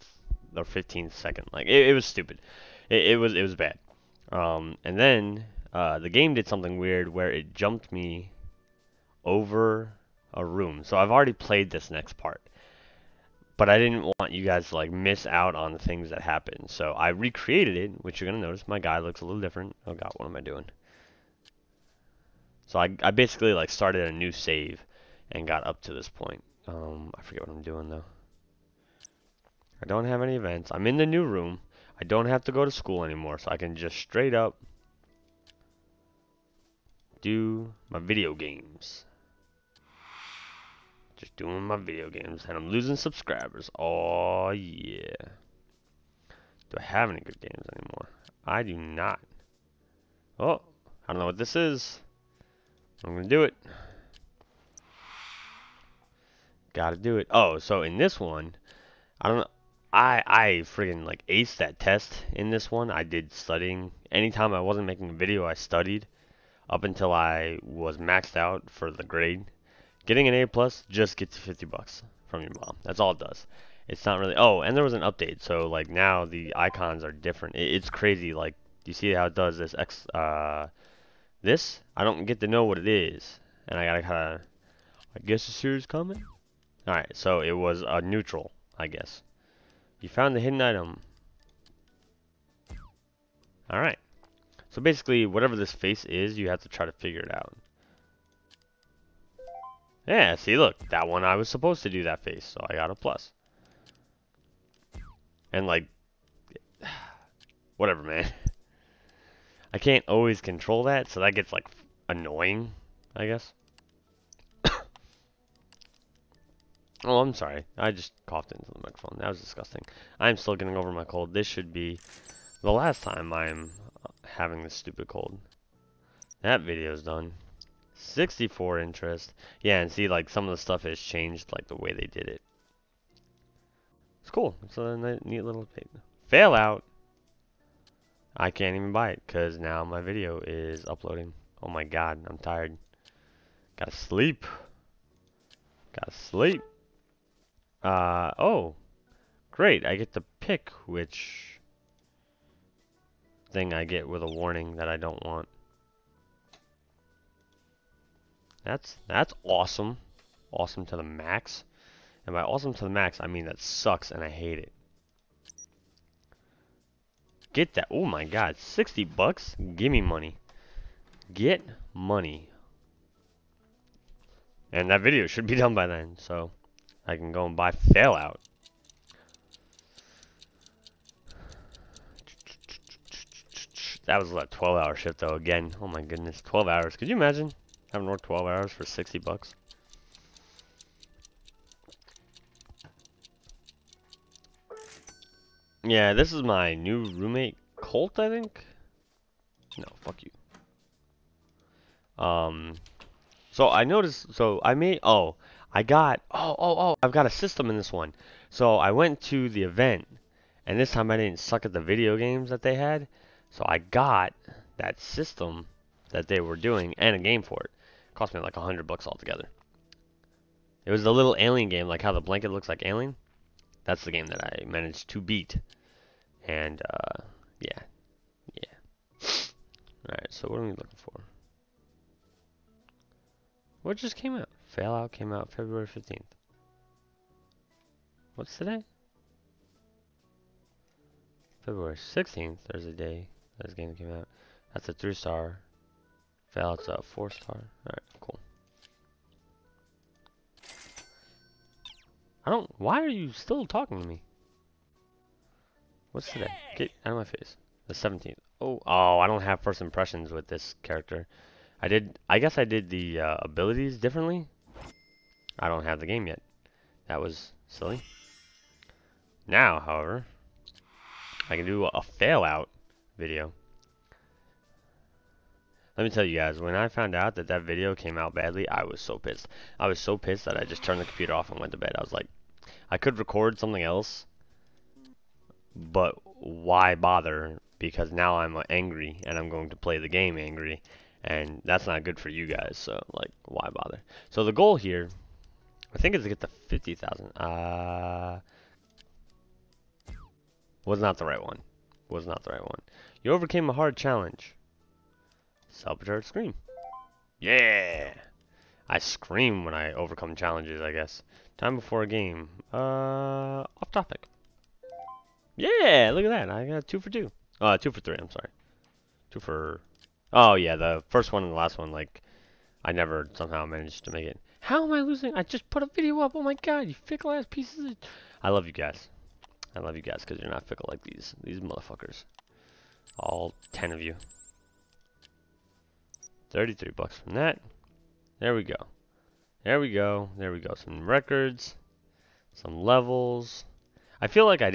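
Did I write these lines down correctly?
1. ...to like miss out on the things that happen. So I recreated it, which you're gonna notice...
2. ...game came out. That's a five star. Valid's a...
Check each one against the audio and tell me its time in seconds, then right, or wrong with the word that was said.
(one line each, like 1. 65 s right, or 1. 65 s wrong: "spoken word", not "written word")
1. 14 s right
2. 243 s wrong: "three", not "five".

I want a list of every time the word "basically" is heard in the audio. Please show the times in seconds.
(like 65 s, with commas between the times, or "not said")
23 s, 94 s.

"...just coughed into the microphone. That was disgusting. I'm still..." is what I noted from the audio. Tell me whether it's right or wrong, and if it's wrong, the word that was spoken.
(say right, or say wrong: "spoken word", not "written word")
right.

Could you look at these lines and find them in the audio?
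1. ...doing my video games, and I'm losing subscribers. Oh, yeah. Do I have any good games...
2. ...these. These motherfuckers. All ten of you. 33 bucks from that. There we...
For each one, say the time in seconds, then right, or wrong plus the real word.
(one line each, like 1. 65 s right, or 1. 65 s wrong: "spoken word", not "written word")
1. 41 s right
2. 331 s right.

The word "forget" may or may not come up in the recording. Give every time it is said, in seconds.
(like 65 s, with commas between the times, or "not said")
27 s.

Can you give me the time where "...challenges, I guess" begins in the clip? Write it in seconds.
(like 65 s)
310 s.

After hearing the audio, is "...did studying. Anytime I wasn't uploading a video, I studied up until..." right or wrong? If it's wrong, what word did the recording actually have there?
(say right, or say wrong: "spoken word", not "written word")
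wrong: "making", not "uploading".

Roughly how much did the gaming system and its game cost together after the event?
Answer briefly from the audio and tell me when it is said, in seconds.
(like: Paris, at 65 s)
a hundred bucks, at 218 s.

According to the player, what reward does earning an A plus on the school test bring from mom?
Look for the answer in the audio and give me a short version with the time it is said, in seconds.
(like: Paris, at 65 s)
50 bucks, at 71 s.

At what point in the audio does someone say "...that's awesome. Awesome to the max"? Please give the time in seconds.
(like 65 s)
159 s.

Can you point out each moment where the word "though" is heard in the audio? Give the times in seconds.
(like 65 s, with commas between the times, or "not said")
27 s, 185 s.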